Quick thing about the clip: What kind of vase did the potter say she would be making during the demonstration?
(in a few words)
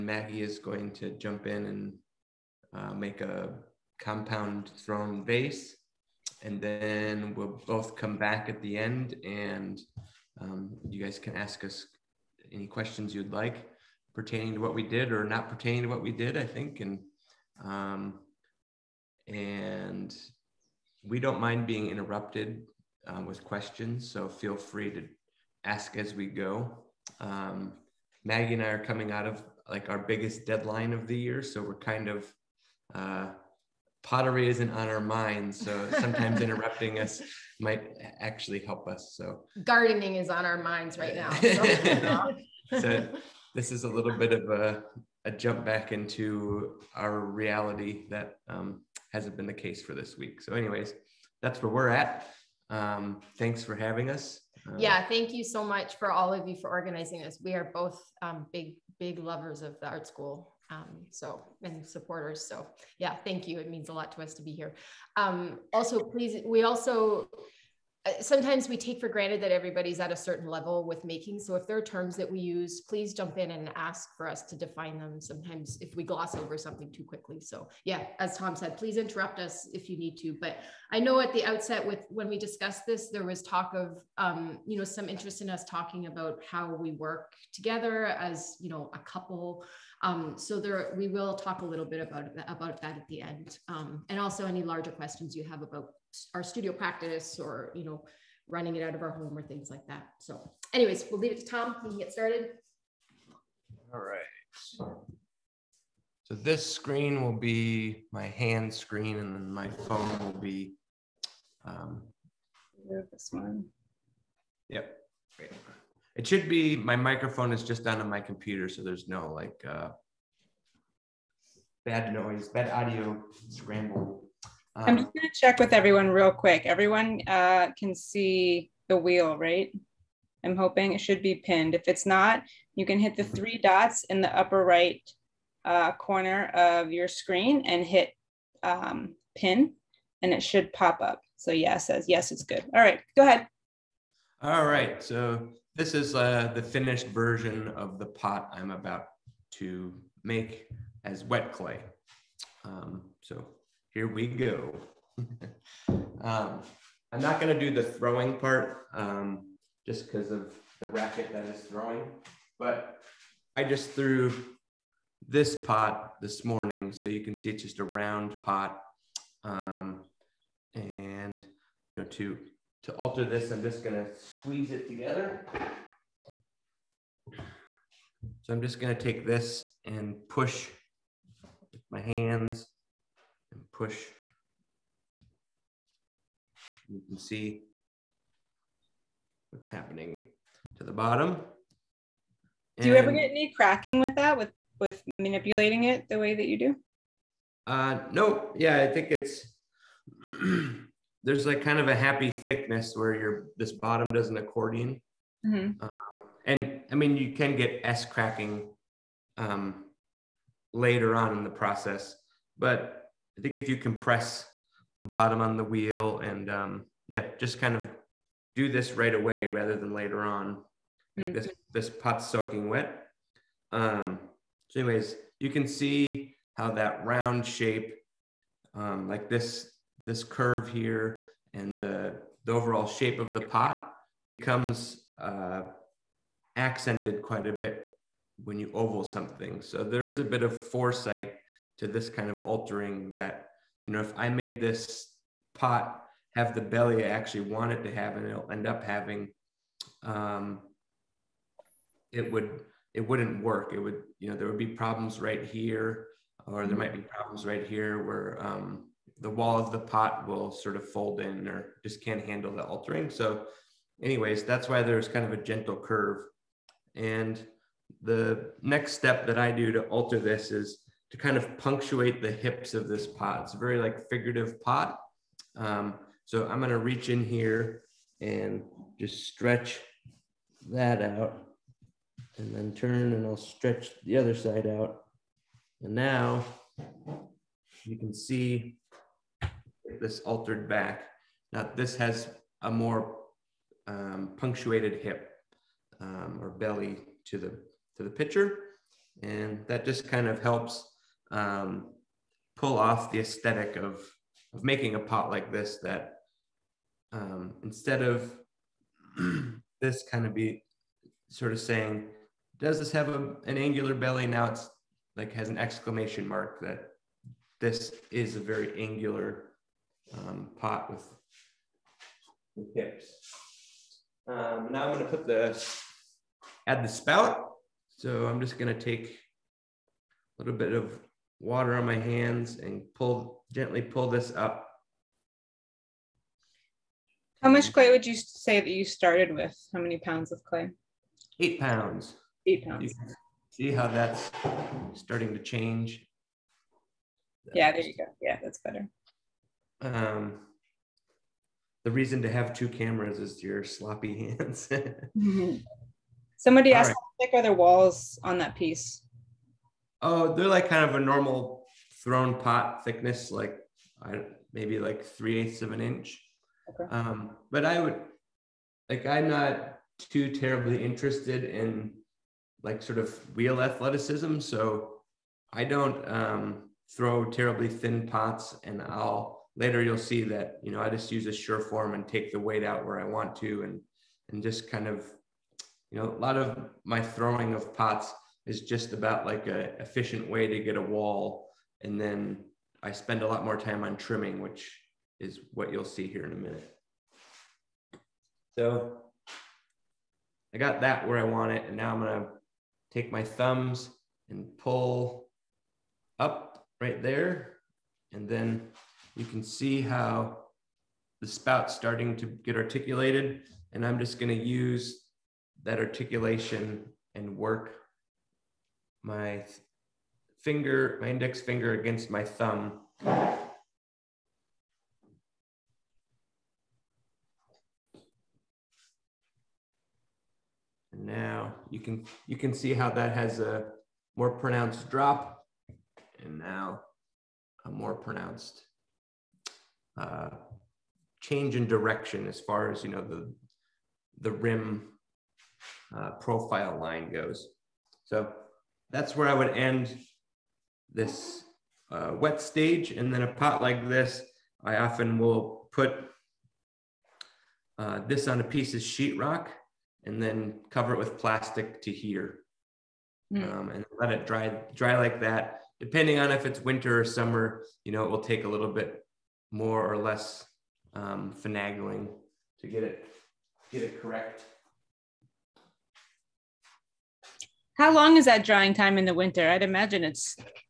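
compound thrown vase.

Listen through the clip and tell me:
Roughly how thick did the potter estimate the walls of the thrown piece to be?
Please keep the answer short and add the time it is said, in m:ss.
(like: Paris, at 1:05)
3/8 of an inch, at 6:05.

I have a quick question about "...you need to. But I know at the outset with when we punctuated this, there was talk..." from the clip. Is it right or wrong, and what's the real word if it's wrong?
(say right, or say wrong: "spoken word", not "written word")
wrong: "discussed", not "punctuated".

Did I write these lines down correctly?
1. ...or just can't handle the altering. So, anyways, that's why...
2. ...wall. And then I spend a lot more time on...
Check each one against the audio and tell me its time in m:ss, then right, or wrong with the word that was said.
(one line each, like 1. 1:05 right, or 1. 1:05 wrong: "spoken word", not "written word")
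1. 4:21 right
2. 6:30 right.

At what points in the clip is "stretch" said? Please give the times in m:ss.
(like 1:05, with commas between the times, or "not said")
4:39, 4:43.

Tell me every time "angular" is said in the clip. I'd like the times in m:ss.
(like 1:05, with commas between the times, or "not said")
5:13, 5:18.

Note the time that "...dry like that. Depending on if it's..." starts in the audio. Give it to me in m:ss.
7:44.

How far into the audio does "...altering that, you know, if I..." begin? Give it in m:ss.
4:02.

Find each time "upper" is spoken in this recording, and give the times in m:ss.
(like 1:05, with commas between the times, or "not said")
2:14.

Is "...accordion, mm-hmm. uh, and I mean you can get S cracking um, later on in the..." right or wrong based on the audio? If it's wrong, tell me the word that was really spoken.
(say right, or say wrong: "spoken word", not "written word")
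right.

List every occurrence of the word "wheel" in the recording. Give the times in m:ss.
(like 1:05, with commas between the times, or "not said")
2:08, 3:35, 6:13.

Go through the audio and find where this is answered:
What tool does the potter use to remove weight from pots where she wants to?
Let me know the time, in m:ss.
6:21.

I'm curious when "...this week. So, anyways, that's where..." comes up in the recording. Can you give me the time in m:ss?
0:49.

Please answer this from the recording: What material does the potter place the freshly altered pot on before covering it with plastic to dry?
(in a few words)
sheetrock.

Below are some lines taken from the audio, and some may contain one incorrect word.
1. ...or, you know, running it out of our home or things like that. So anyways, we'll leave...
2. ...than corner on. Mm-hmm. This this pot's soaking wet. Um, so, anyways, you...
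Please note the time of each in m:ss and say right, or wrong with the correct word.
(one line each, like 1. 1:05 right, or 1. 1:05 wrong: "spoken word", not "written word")
1. 1:37 right
2. 3:39 wrong: "later", not "corner".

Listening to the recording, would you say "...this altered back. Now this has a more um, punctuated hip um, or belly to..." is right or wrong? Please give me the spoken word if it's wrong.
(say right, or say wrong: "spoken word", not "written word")
right.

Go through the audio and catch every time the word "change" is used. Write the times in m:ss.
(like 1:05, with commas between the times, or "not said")
5:45, 7:21.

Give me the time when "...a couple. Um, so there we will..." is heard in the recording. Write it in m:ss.
1:28.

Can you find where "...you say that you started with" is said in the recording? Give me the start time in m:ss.
5:38.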